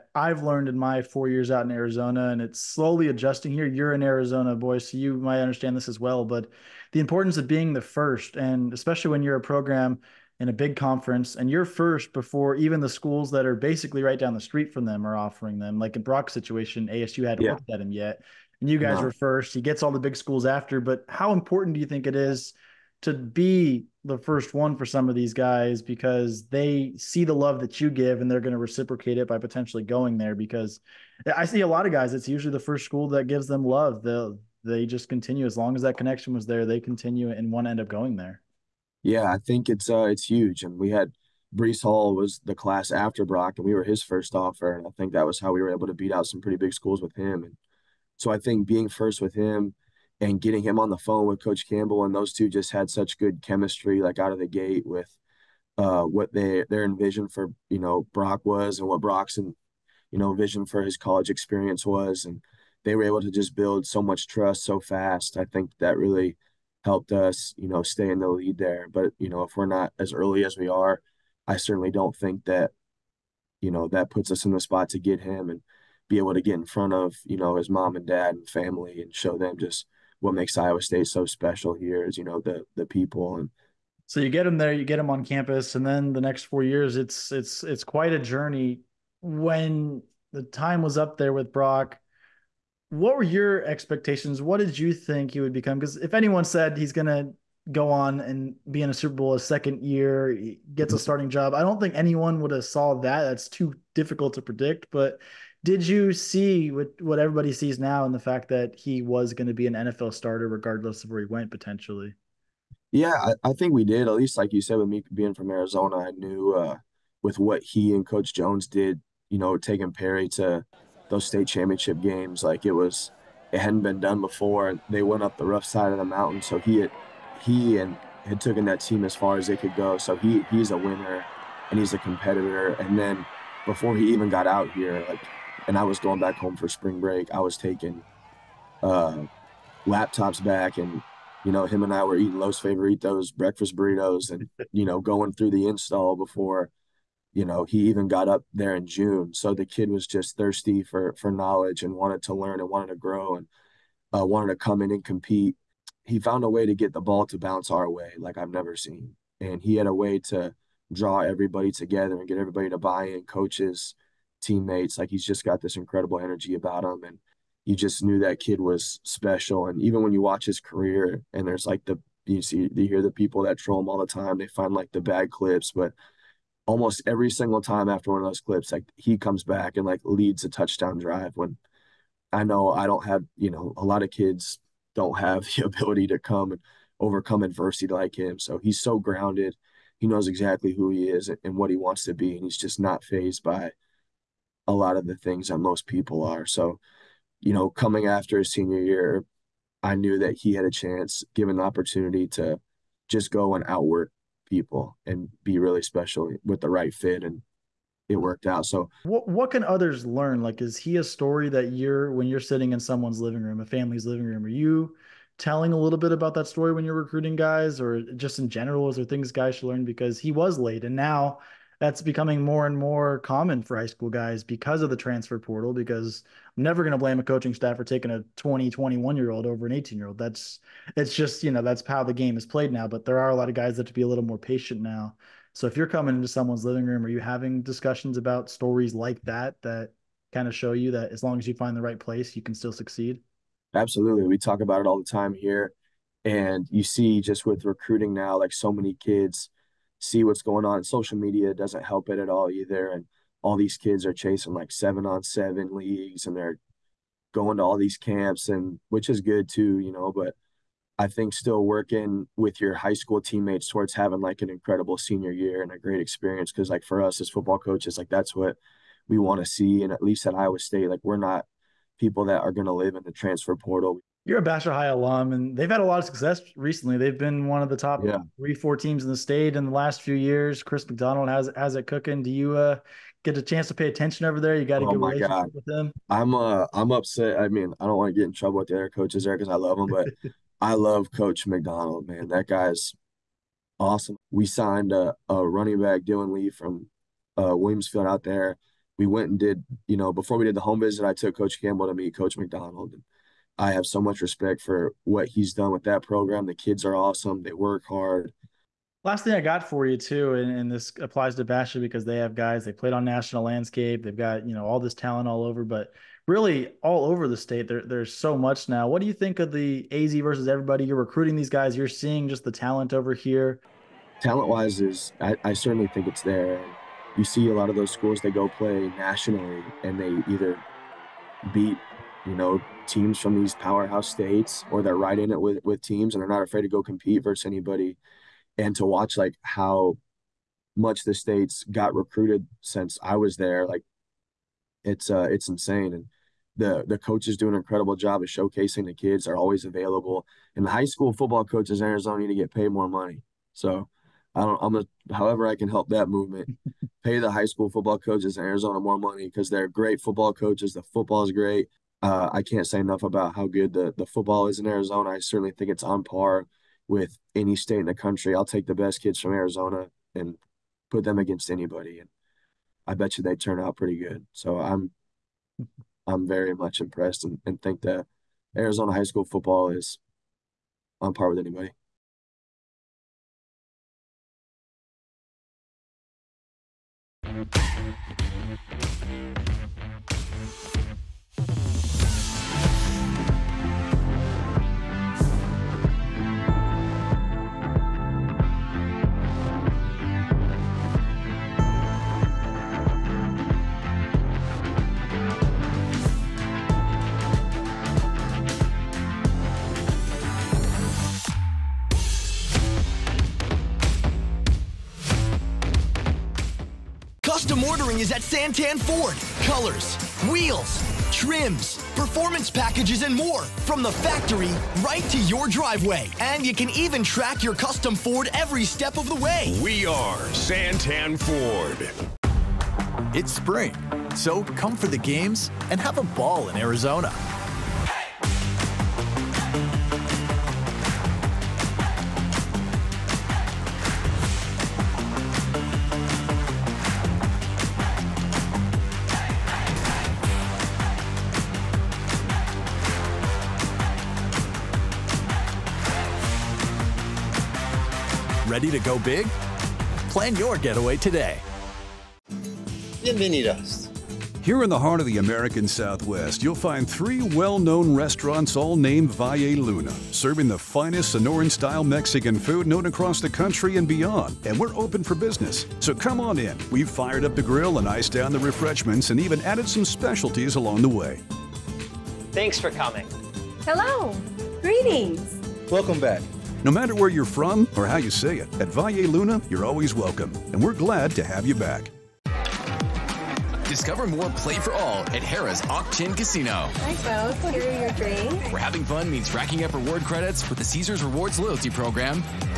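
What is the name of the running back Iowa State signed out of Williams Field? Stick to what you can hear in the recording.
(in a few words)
Dylan Lee.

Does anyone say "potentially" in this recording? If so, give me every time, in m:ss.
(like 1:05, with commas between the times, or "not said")
0:29, 1:51.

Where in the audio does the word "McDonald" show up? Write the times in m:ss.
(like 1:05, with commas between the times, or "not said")
4:40, 4:51, 5:02.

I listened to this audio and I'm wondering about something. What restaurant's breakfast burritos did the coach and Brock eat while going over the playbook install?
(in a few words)
Los Favoritos.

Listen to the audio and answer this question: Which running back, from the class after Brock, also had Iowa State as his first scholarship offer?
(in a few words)
Breece Hall.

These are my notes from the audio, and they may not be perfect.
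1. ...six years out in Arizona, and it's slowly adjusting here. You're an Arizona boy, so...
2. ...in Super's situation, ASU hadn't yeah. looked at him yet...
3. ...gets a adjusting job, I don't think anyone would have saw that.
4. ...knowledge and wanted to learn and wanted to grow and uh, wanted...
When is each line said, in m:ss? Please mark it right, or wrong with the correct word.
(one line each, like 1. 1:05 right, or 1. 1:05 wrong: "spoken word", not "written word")
1. 0:01 wrong: "four", not "six"
2. 0:15 wrong: "Brock", not "Super"
3. 1:40 wrong: "starting", not "adjusting"
4. 2:31 right.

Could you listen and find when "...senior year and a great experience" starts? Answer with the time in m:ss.
4:24.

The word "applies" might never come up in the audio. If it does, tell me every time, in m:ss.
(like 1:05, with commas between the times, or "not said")
5:10.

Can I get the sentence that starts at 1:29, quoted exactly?
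When the time was up there with Brock, what were your expectations?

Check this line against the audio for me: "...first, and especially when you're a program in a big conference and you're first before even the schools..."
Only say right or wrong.
right.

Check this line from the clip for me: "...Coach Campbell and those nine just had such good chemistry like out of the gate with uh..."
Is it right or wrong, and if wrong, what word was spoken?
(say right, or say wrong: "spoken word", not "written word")
wrong: "two", not "nine".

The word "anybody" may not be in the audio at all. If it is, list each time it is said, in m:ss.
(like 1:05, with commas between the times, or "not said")
5:37, 6:11, 6:21.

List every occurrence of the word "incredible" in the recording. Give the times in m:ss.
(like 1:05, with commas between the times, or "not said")
2:45, 4:24, 5:47.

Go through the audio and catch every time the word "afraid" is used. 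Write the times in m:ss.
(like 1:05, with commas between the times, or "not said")
5:36.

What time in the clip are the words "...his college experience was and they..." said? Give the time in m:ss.
1:00.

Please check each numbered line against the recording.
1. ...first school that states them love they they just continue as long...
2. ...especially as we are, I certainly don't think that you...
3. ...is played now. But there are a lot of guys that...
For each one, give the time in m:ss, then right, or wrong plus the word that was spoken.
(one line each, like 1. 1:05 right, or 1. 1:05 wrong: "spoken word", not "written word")
1. 0:32 wrong: "gives", not "states"
2. 1:10 wrong: "early", not "especially"
3. 3:52 right.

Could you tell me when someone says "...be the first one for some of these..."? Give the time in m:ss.
0:23.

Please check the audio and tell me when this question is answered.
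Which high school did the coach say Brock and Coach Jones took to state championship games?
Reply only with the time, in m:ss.
1:59.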